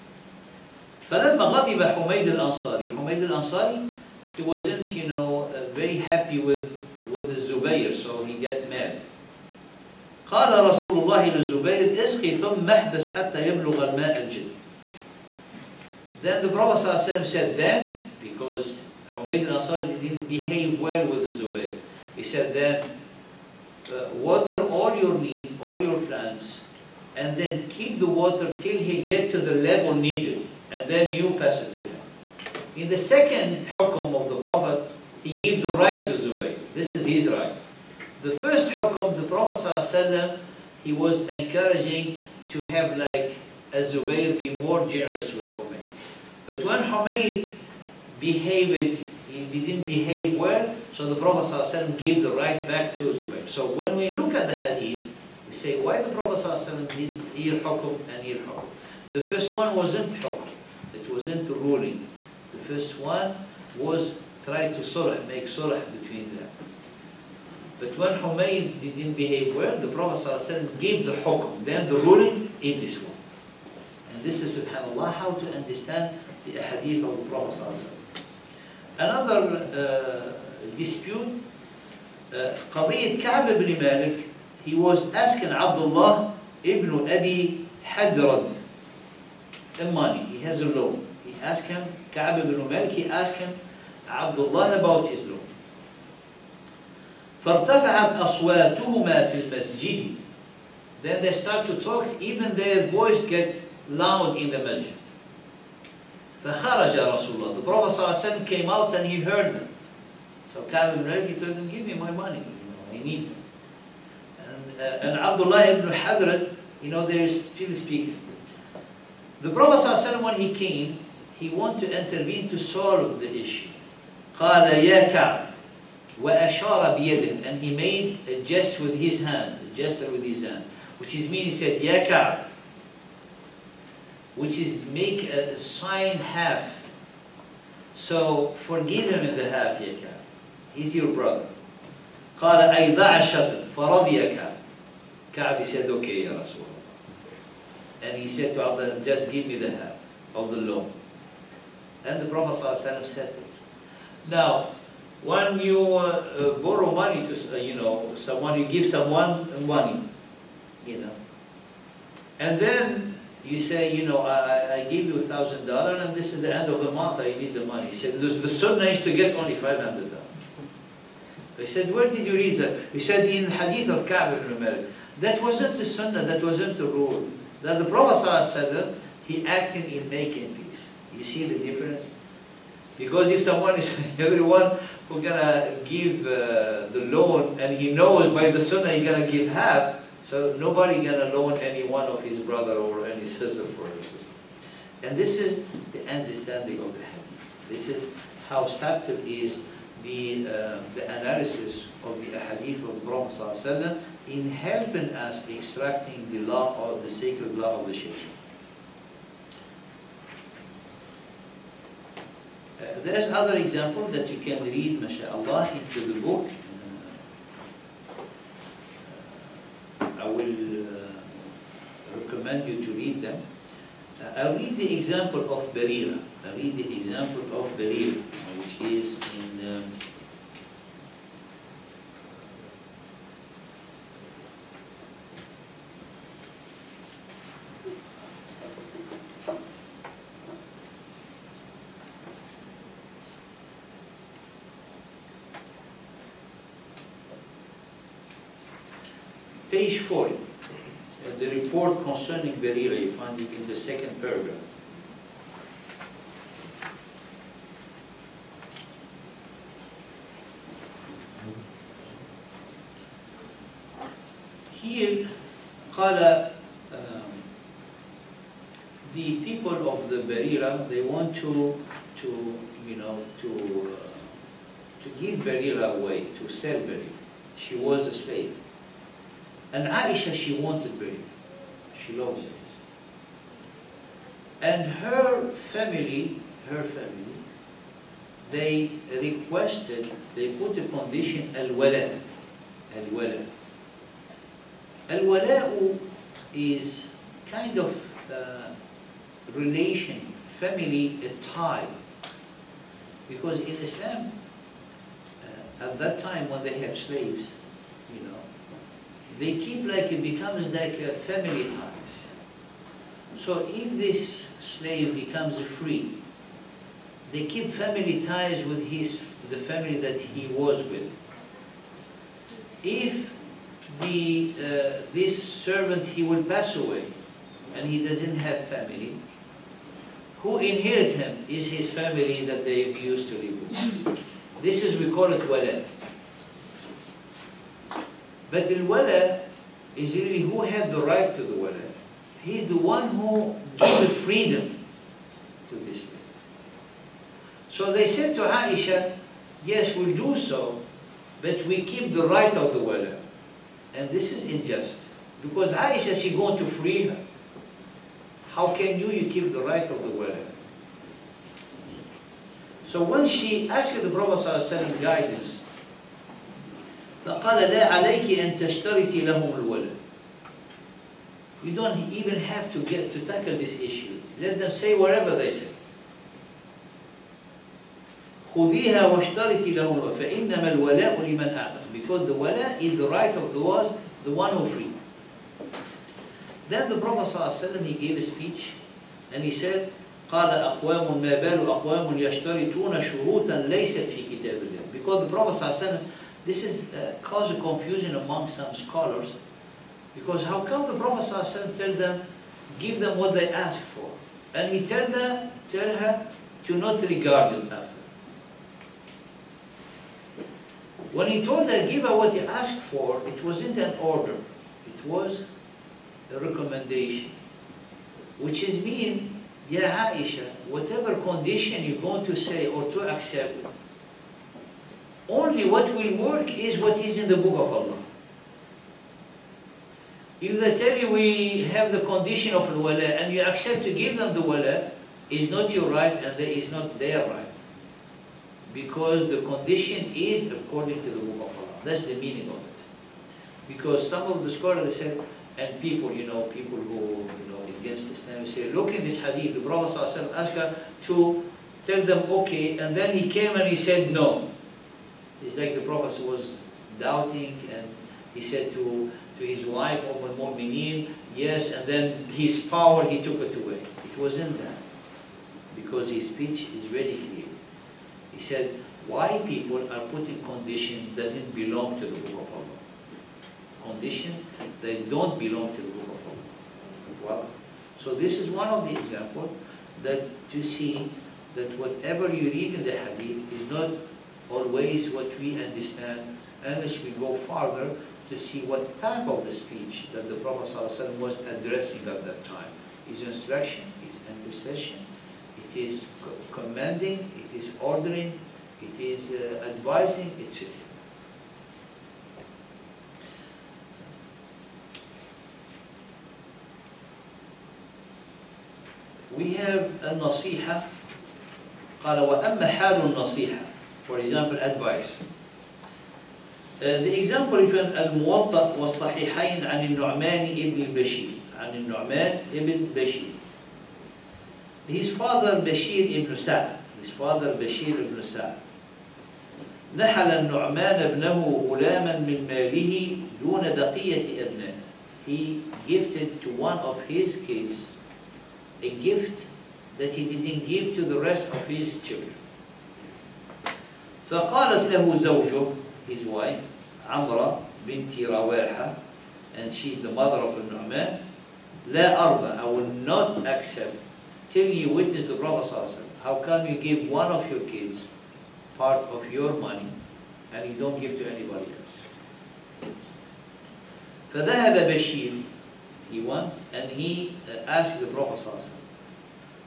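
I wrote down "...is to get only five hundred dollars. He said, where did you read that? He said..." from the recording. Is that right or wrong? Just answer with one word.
right.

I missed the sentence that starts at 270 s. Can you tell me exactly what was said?
they want to, to you know, to, uh, to give Barira away, to sell Barira.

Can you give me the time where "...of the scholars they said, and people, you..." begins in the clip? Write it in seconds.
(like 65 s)
444 s.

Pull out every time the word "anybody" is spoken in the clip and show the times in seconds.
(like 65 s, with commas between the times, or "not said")
561 s.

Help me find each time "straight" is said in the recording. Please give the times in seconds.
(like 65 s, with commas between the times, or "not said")
not said.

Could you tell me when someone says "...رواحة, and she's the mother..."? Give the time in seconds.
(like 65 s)
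548 s.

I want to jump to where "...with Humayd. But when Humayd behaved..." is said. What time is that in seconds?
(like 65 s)
45 s.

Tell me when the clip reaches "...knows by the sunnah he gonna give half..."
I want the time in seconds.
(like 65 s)
187 s.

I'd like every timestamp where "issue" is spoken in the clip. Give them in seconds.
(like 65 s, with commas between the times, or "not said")
123 s, 373 s.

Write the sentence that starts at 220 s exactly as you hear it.
Uh, I will uh, recommend you to read them.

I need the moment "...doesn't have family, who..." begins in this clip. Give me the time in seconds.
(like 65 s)
328 s.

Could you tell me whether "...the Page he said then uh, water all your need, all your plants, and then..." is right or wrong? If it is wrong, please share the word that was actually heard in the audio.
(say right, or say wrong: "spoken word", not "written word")
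wrong: "Zubayr", not "Page".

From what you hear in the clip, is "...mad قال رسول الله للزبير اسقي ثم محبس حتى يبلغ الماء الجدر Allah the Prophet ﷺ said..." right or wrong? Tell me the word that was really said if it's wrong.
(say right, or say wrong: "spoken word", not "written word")
wrong: "Then", not "Allah".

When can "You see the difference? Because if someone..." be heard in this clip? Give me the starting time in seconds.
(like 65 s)
181 s.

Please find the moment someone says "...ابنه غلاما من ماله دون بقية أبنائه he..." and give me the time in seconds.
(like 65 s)
531 s.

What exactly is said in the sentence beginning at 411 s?
When he told her, give her what you asked for, it wasn't an order.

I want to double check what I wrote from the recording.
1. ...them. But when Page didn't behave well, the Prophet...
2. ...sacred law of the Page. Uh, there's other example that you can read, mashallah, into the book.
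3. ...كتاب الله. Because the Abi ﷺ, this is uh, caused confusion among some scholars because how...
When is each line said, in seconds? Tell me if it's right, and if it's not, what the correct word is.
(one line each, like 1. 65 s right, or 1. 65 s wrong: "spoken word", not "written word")
1. 66 s wrong: "Humayd", not "Page"
2. 207 s wrong: "Sharia", not "Page"
3. 394 s wrong: "Prophet", not "Abi".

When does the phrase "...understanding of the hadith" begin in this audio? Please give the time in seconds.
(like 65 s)
196 s.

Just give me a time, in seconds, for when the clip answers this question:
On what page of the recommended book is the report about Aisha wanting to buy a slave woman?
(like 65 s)
249 s.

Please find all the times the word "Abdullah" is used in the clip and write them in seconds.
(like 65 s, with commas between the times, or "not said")
85 s, 94 s, 115 s, 148 s.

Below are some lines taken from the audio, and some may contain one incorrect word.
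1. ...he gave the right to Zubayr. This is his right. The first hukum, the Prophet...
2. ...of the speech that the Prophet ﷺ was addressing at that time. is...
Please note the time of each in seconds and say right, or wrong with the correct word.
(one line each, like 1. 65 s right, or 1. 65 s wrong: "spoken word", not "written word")
1. 35 s right
2. 489 s right.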